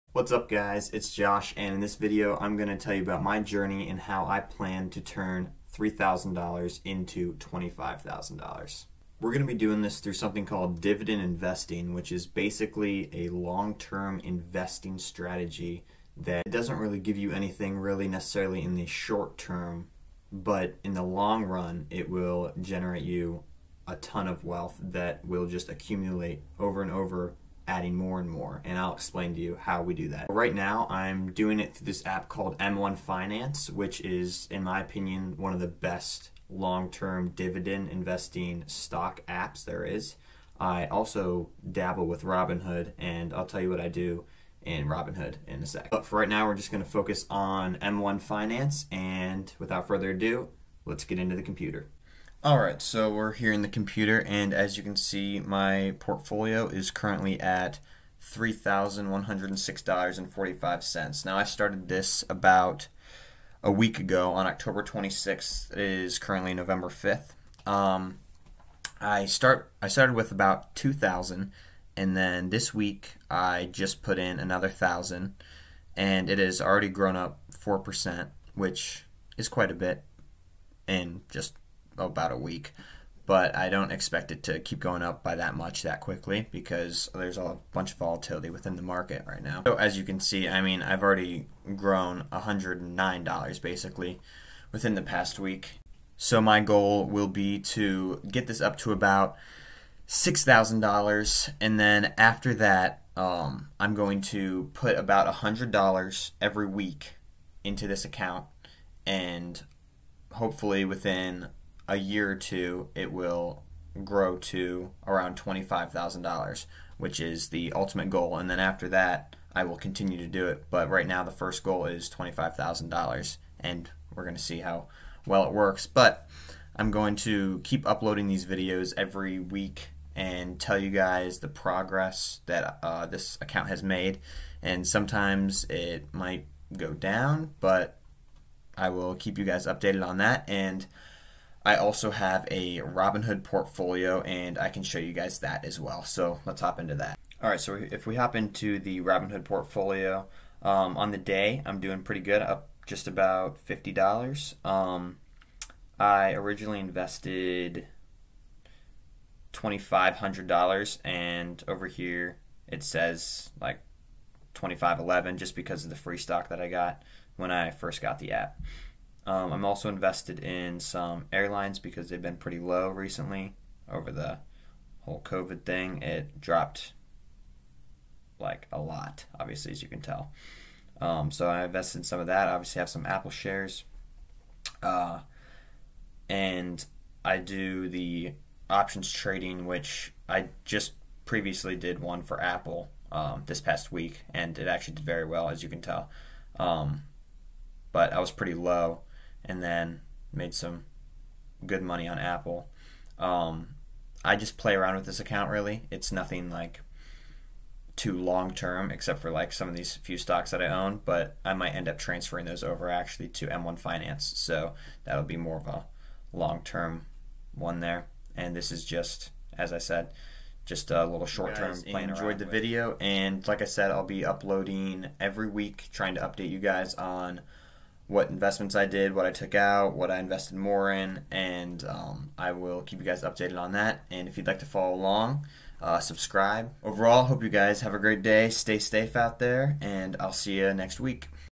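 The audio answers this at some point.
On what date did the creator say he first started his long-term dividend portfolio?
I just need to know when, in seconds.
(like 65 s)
64 s.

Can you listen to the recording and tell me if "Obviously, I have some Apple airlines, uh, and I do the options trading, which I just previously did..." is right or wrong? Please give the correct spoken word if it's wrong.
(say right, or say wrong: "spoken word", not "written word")
wrong: "shares", not "airlines".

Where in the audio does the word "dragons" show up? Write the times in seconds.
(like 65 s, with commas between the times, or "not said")
not said.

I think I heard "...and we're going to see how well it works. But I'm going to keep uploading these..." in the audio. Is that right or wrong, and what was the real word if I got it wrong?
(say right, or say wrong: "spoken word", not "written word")
right.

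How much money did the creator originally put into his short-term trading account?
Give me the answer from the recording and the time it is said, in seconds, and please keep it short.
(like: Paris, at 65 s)
$2,500, at 159 s.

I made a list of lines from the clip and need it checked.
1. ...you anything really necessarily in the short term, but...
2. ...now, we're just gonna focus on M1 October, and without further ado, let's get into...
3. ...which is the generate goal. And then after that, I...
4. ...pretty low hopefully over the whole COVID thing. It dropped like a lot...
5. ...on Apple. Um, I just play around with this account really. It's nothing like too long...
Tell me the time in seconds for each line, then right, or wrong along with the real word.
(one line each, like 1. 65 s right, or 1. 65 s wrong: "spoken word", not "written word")
1. 17 s right
2. 46 s wrong: "Finance", not "October"
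3. 116 s wrong: "ultimate", not "generate"
4. 172 s wrong: "recently", not "hopefully"
5. 202 s right.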